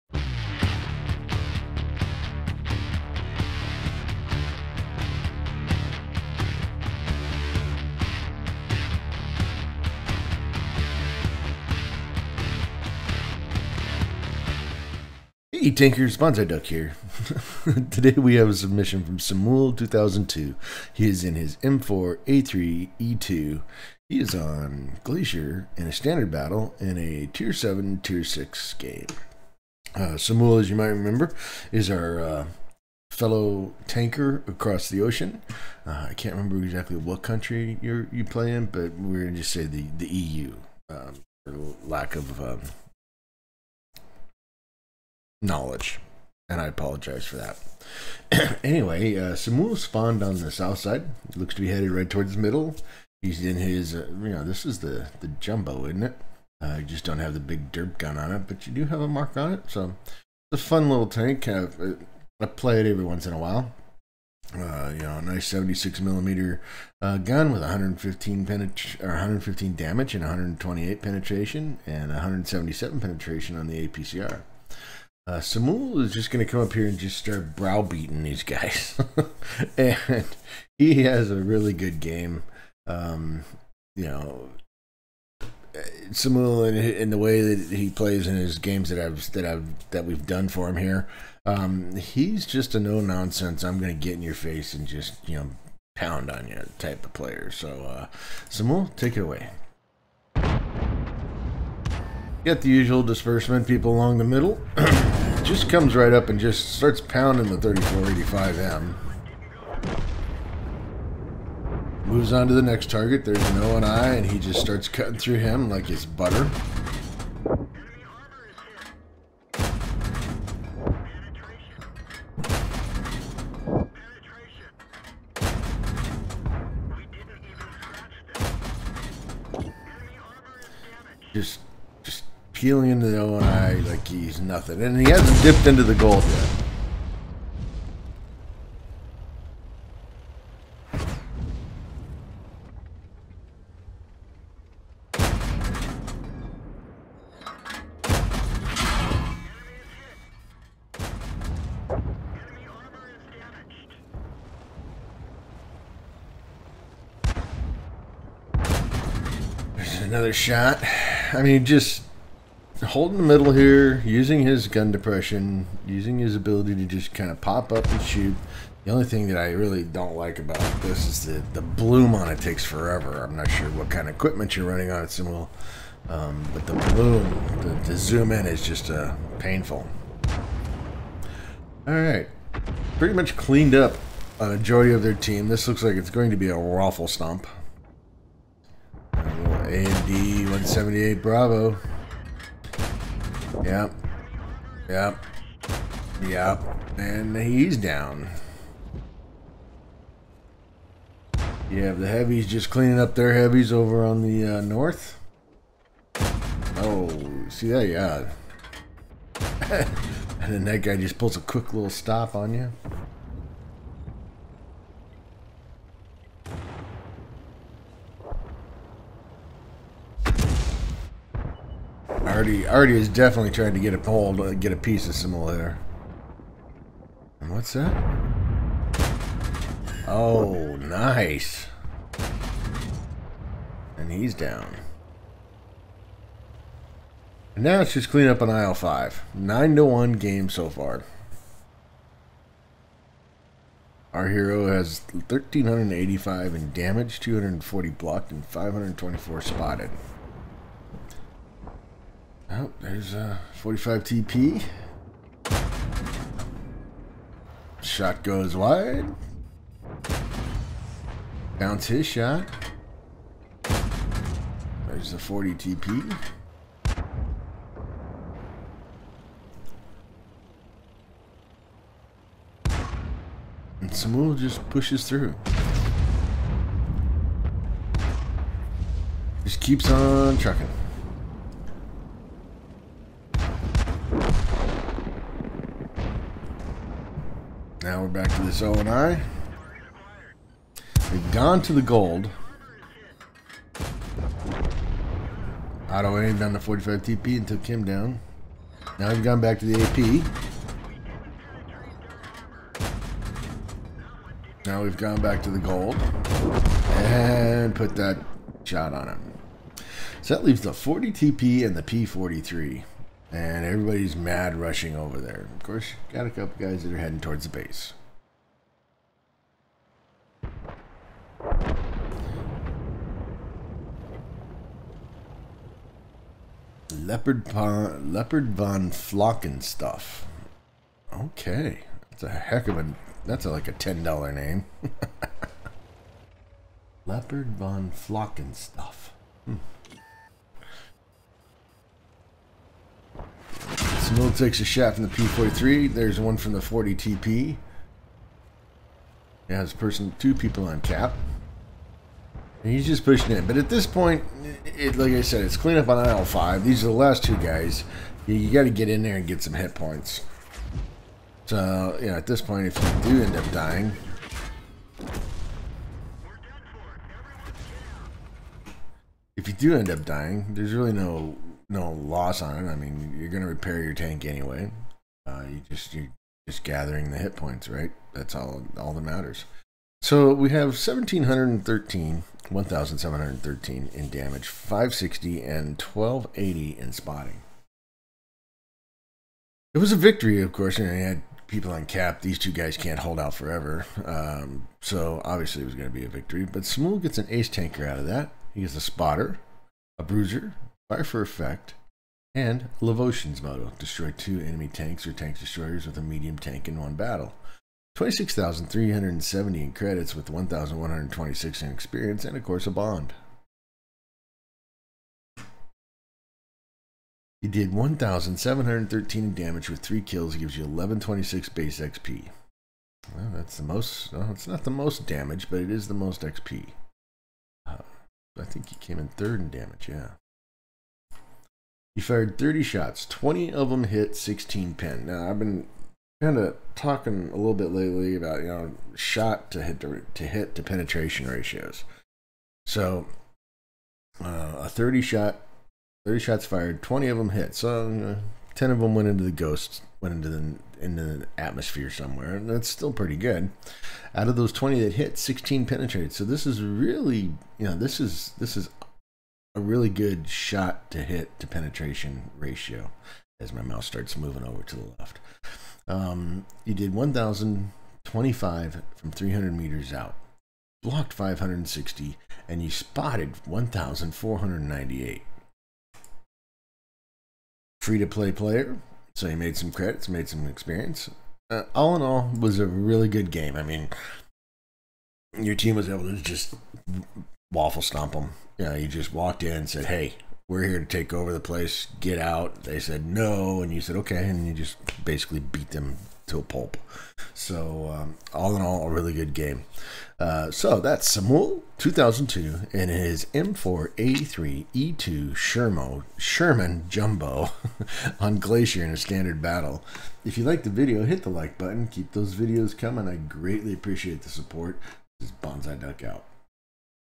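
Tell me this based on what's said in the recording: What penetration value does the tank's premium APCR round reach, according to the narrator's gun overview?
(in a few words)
177.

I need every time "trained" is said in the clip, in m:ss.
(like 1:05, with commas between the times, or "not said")
not said.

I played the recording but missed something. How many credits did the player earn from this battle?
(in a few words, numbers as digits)
26,370.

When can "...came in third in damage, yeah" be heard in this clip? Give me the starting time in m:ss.
7:08.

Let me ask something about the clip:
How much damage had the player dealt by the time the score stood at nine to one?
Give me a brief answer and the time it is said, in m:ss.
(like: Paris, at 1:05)
1,385, at 4:05.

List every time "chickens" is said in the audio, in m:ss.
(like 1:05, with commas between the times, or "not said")
not said.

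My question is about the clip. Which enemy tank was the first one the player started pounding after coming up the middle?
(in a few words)
3485M.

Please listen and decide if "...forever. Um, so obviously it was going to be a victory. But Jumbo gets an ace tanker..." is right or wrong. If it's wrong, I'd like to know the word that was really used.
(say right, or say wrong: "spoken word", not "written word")
wrong: "Smoo", not "Jumbo".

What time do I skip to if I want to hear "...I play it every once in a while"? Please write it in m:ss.
1:02.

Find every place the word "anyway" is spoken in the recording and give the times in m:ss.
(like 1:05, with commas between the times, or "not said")
0:48, 6:14.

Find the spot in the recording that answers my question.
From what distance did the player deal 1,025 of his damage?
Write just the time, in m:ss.
7:49.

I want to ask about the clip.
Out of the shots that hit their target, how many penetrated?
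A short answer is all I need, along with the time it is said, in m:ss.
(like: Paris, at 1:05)
16, at 7:35.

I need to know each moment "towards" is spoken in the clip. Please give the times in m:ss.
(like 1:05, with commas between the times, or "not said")
0:52, 5:17.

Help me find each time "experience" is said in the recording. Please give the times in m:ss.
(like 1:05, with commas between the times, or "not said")
6:51, 8:00.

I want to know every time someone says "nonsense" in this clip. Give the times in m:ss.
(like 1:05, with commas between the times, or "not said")
1:32.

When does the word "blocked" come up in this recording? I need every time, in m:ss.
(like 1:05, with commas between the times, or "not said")
4:07, 7:50.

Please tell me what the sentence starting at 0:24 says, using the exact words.
He is on Glacier in a standard battle in a Tier 7, Tier 6 game.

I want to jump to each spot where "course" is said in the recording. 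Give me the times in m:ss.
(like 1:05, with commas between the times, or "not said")
5:15, 6:30, 6:52.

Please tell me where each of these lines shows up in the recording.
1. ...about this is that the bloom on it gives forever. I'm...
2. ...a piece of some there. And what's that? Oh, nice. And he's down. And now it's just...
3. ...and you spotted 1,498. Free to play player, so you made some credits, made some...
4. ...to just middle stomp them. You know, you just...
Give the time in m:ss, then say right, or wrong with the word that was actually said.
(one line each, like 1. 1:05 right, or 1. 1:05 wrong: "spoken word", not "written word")
1. 2:50 wrong: "takes", not "gives"
2. 3:44 right
3. 7:52 right
4. 8:06 wrong: "waffle", not "middle".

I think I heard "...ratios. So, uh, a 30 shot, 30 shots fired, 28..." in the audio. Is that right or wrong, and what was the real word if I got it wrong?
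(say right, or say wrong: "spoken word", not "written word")
wrong: "20", not "28".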